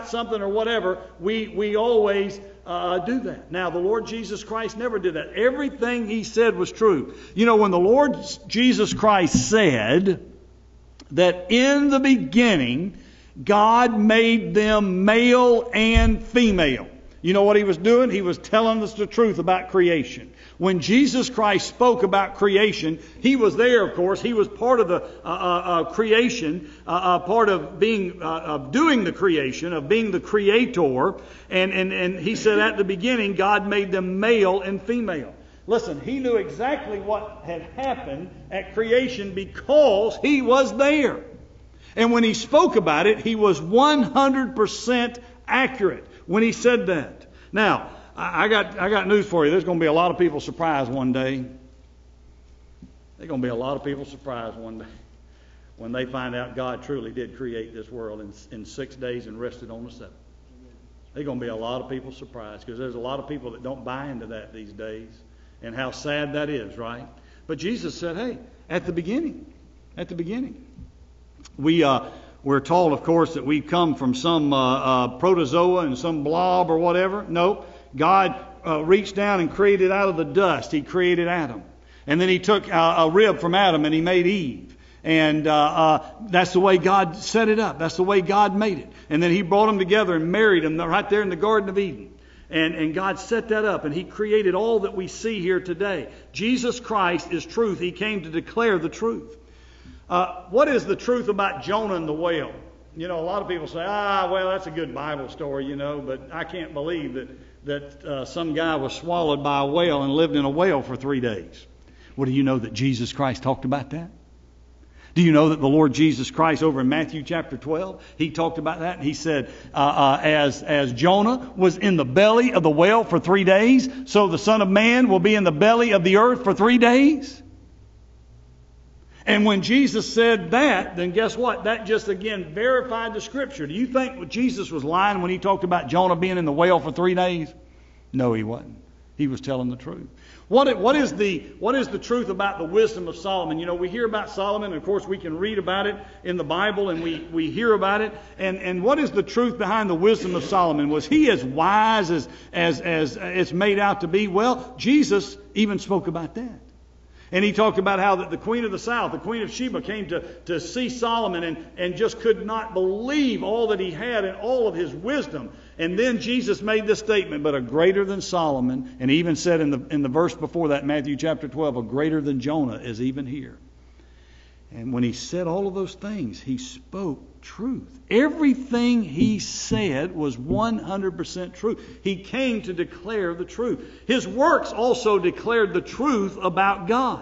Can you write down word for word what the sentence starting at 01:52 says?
Well, do you know that Jesus Christ talked about that?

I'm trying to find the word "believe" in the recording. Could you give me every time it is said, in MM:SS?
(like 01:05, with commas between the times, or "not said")
01:46, 02:42.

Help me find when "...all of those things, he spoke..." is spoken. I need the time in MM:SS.
02:55.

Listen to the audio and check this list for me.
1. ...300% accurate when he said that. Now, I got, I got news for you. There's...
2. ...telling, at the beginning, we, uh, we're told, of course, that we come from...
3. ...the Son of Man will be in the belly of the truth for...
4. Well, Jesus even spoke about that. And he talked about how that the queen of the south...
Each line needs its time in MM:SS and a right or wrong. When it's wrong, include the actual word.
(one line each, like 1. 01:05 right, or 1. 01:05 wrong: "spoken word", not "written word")
1. 00:43 wrong: "100", not "300"
2. 01:08 wrong: "beginning", not "telling"
3. 02:04 wrong: "earth", not "truth"
4. 02:34 right.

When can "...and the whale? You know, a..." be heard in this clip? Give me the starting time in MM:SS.
01:41.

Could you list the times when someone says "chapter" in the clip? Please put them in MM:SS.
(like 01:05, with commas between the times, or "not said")
01:57, 02:51.